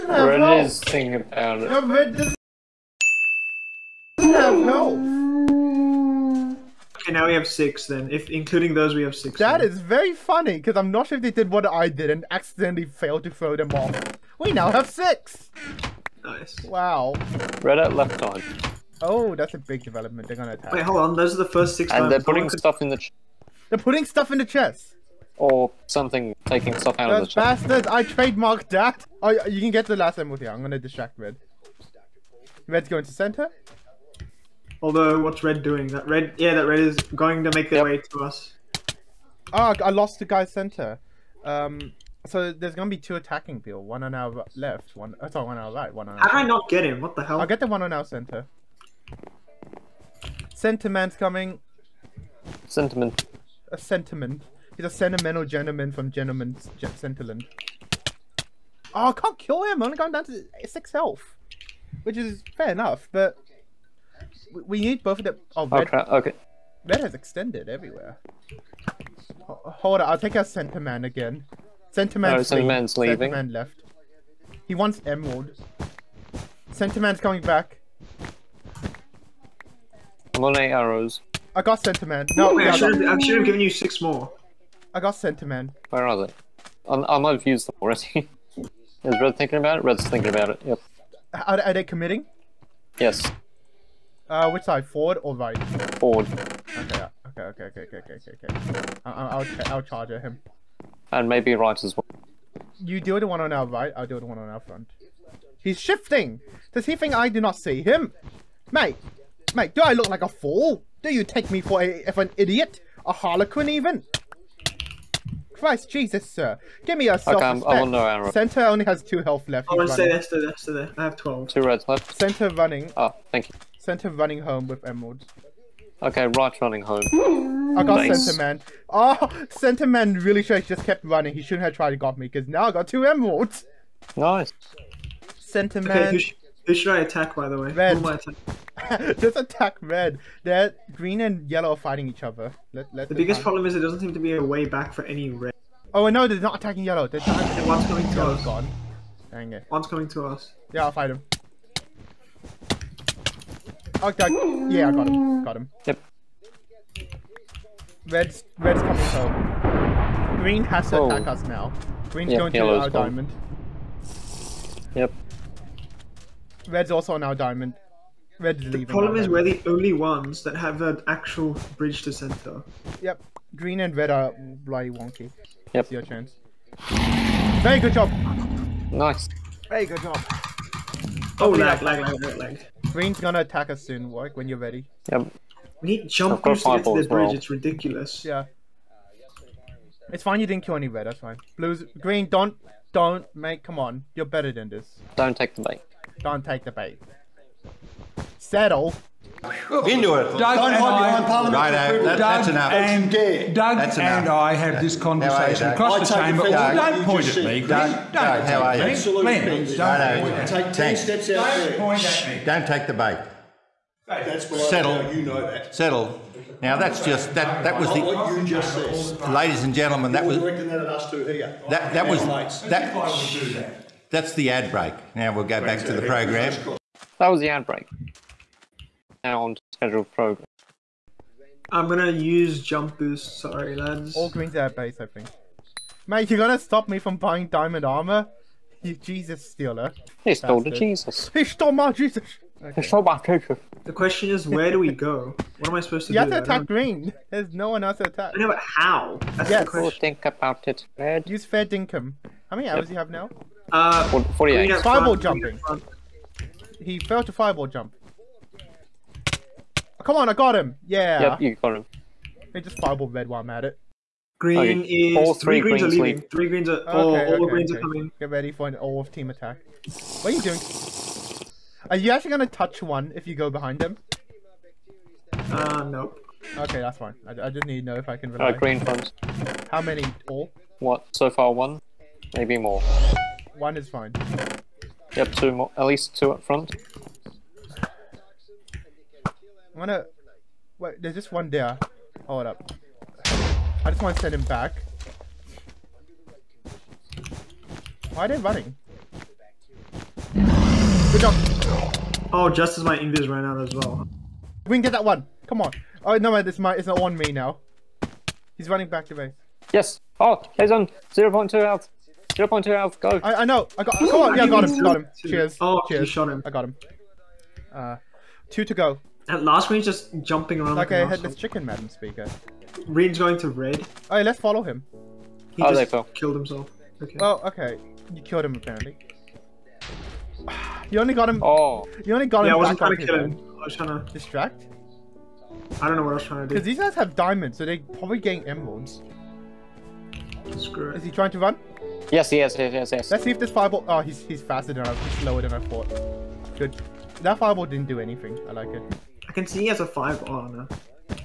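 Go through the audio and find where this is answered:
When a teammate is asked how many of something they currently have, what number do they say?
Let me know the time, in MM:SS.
04:14.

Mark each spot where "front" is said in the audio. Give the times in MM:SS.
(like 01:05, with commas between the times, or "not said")
01:44, 04:46.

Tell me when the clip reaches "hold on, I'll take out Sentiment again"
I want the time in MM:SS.
01:09.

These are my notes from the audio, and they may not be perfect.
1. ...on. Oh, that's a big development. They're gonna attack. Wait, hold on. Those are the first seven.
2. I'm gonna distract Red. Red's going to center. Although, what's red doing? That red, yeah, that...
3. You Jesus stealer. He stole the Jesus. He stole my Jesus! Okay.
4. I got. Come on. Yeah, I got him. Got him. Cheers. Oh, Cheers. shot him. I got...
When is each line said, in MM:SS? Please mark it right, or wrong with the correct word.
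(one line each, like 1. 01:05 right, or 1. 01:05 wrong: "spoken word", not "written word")
1. 00:18 wrong: "six", not "seven"
2. 00:30 right
3. 03:58 right
4. 05:13 right.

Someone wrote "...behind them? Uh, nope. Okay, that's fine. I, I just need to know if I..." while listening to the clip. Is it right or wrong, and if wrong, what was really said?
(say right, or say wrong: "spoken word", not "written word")
right.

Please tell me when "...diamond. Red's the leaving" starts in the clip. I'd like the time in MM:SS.
02:47.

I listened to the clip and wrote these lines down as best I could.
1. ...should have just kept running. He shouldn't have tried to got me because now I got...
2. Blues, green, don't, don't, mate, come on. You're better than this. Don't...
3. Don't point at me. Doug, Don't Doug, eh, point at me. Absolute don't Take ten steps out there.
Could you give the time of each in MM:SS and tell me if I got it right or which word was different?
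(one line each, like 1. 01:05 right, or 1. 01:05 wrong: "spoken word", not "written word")
1. 02:10 right
2. 03:11 right
3. 03:26 right.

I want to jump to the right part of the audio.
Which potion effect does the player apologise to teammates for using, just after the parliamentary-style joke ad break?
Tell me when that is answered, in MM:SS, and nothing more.
03:52.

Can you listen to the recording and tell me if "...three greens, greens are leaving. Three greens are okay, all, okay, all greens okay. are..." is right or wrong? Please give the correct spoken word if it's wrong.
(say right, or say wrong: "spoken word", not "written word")
right.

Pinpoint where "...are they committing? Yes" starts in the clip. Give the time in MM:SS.
01:31.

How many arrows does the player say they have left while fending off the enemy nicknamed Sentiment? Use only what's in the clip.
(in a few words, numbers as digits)
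8.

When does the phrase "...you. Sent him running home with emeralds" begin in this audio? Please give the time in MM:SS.
02:03.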